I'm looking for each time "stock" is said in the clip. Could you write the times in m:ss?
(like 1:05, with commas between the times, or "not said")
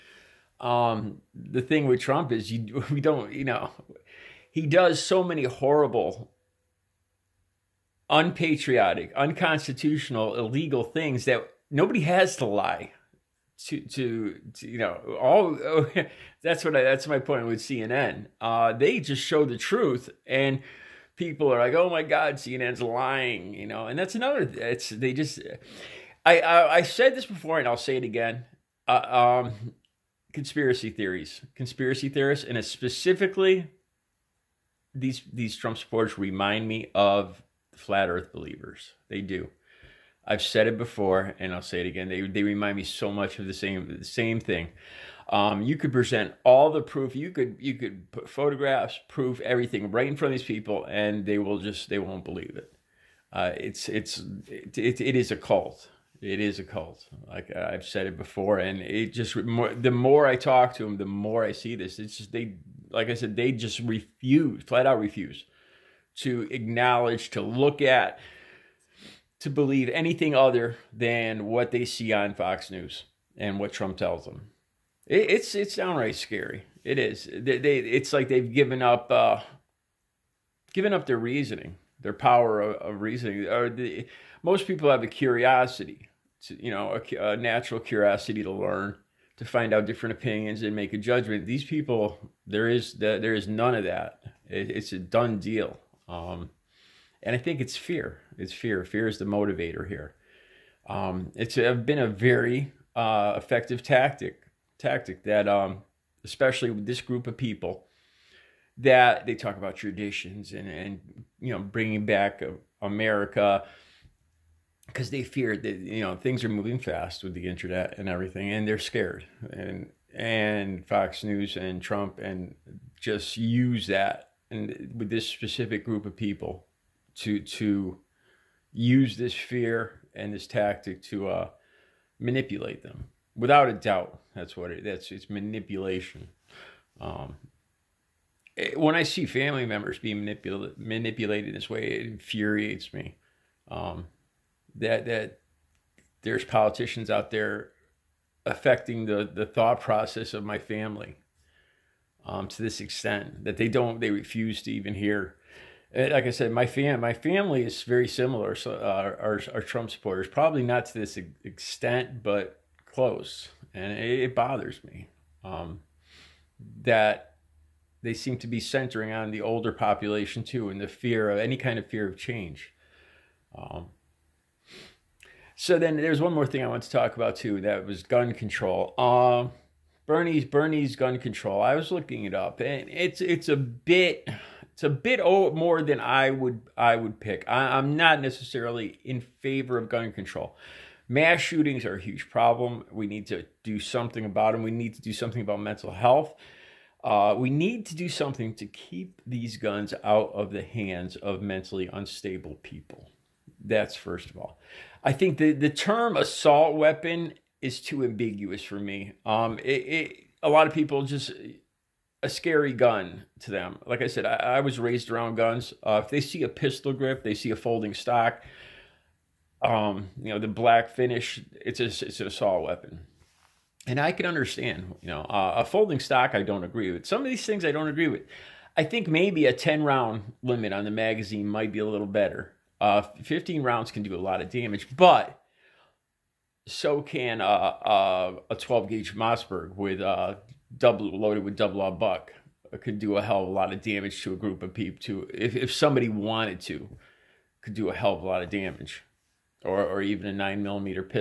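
3:37, 3:46.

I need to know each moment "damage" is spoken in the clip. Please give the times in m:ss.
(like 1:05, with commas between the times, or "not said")
3:54, 4:03, 4:08.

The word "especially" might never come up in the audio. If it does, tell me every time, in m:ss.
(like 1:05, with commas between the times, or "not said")
1:46.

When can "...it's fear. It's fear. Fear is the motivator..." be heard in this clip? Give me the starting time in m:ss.
1:37.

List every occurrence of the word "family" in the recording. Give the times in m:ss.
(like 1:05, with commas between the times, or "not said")
2:19, 2:30, 2:37.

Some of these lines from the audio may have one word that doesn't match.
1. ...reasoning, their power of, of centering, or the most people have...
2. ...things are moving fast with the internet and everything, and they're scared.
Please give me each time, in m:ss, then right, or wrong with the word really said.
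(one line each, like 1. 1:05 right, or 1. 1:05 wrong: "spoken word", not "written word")
1. 1:21 wrong: "reasoning", not "centering"
2. 1:56 right.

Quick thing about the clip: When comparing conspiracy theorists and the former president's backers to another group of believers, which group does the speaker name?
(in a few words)
flat Earth believers.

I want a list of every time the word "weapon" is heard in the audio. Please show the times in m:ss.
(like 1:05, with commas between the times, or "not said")
3:26, 3:42.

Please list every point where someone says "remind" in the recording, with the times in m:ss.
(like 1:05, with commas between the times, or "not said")
0:36, 0:42.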